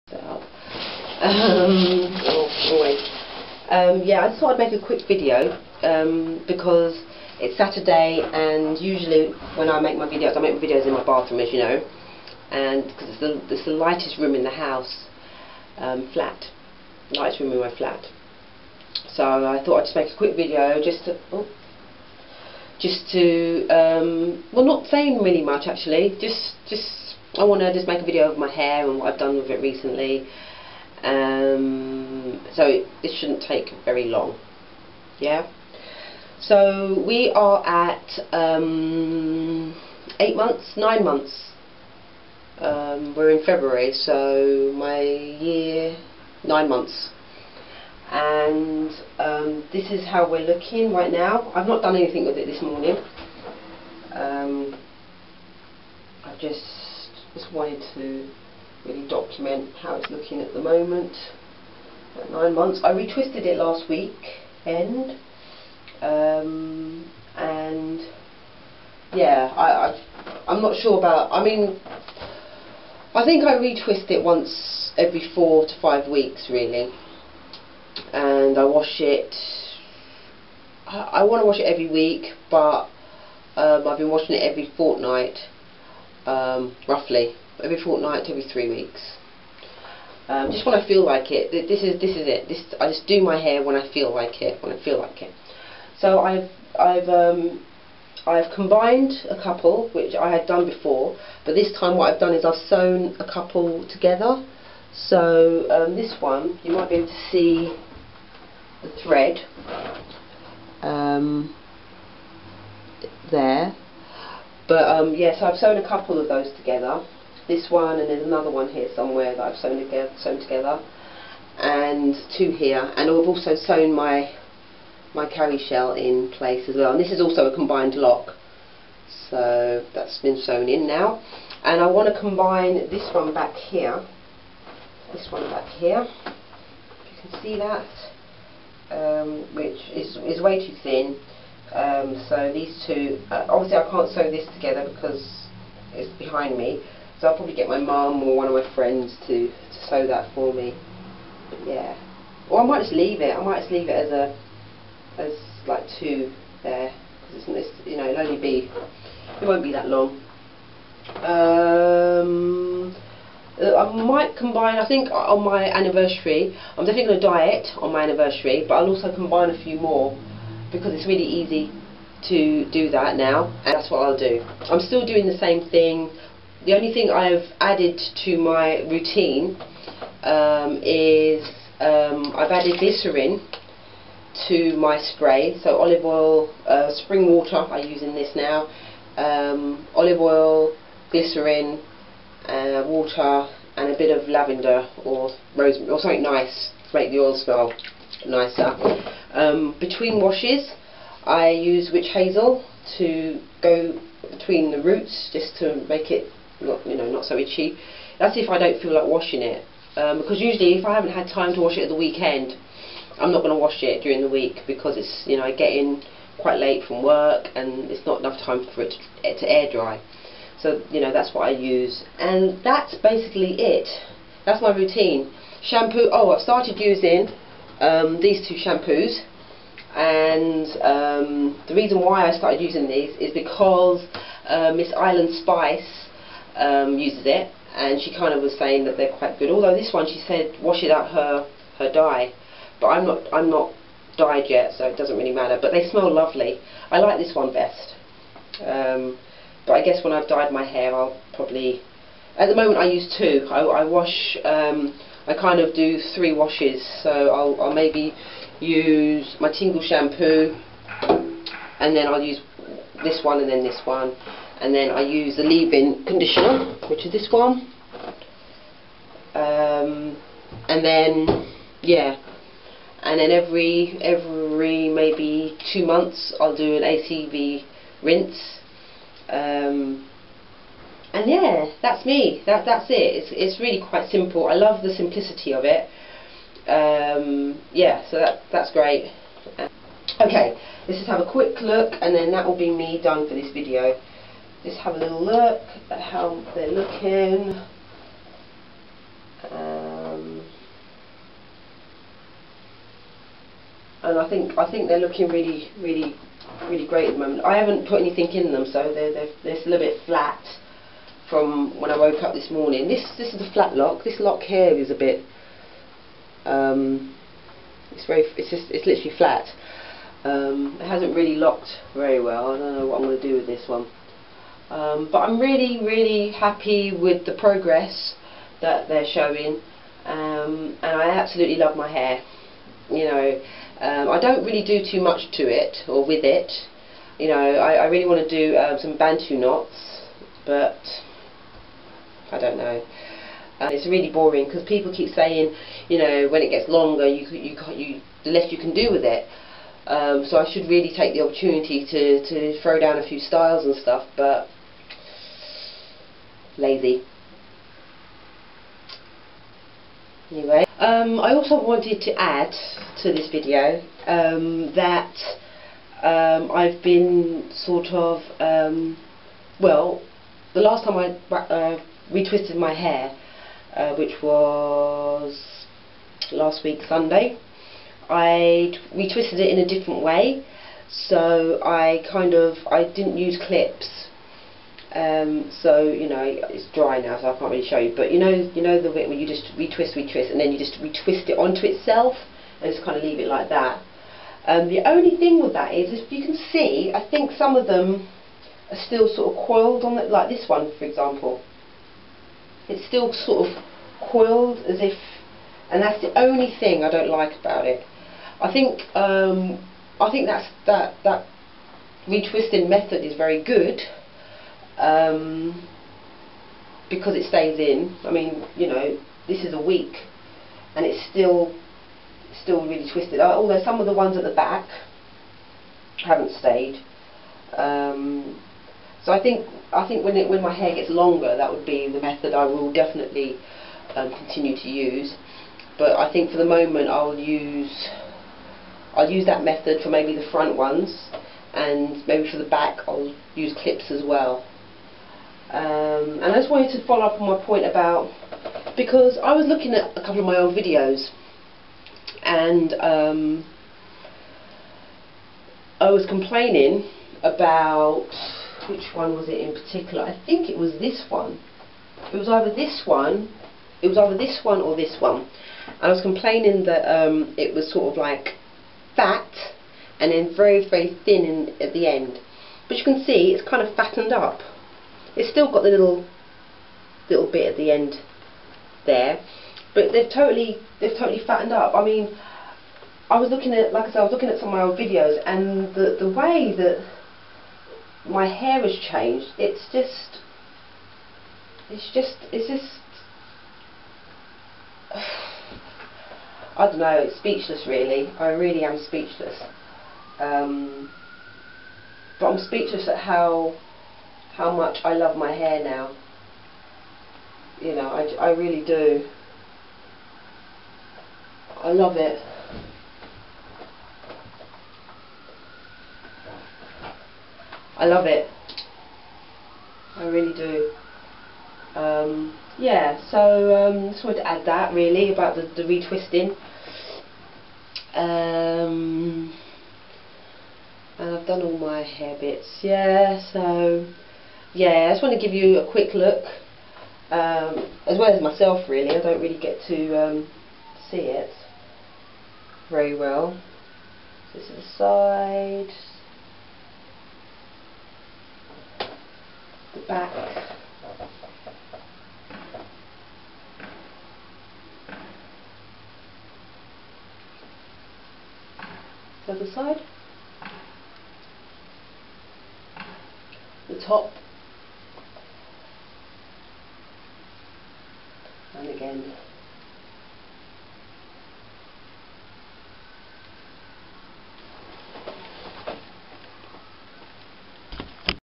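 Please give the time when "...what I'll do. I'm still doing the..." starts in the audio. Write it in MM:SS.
02:53.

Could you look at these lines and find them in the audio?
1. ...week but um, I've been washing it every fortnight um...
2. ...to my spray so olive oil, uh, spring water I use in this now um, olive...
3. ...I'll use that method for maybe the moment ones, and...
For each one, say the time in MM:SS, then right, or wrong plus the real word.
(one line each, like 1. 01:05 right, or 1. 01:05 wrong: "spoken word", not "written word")
1. 01:21 right
2. 03:04 right
3. 07:18 wrong: "front", not "moment".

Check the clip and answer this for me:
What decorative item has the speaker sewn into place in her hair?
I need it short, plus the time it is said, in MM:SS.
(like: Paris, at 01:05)
cowrie shell, at 02:05.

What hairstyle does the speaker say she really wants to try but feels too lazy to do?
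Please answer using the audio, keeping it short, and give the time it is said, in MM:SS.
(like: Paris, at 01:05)
bantu knots, at 05:38.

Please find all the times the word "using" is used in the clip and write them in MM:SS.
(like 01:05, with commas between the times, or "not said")
03:46, 03:52.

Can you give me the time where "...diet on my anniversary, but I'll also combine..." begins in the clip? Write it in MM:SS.
02:47.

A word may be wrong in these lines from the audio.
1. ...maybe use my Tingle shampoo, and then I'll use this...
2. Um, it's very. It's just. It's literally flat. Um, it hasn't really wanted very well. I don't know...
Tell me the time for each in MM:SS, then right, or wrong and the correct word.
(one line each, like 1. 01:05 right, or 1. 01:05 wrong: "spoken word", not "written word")
1. 04:17 right
2. 05:16 wrong: "locked", not "wanted".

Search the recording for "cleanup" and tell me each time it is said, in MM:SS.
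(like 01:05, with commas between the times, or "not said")
not said.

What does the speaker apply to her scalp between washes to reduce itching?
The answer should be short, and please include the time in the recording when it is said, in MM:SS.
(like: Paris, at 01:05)
witch hazel, at 03:21.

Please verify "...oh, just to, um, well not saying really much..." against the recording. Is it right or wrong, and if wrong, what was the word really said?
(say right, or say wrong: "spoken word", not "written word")
right.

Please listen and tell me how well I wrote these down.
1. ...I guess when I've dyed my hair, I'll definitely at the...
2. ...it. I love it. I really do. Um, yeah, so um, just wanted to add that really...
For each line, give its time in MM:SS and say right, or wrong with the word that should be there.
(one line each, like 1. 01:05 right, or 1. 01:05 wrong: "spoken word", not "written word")
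1. 04:09 wrong: "probably", not "definitely"
2. 08:31 right.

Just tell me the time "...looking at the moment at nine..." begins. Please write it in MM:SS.
01:00.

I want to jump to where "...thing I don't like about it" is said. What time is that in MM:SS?
06:46.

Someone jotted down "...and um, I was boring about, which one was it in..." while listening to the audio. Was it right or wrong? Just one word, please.
wrong.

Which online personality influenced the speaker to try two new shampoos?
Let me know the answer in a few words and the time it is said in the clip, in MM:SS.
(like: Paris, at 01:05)
Miss Island Spice, at 03:54.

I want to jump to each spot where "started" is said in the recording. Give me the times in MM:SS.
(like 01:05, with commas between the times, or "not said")
03:46, 03:52.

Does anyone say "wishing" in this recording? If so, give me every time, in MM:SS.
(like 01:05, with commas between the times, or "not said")
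not said.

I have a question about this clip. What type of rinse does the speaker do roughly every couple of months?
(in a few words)
ACV rinse.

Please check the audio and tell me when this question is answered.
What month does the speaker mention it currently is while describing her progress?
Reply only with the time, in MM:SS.
00:43.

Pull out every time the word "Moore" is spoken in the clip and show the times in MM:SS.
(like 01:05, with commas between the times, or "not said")
not said.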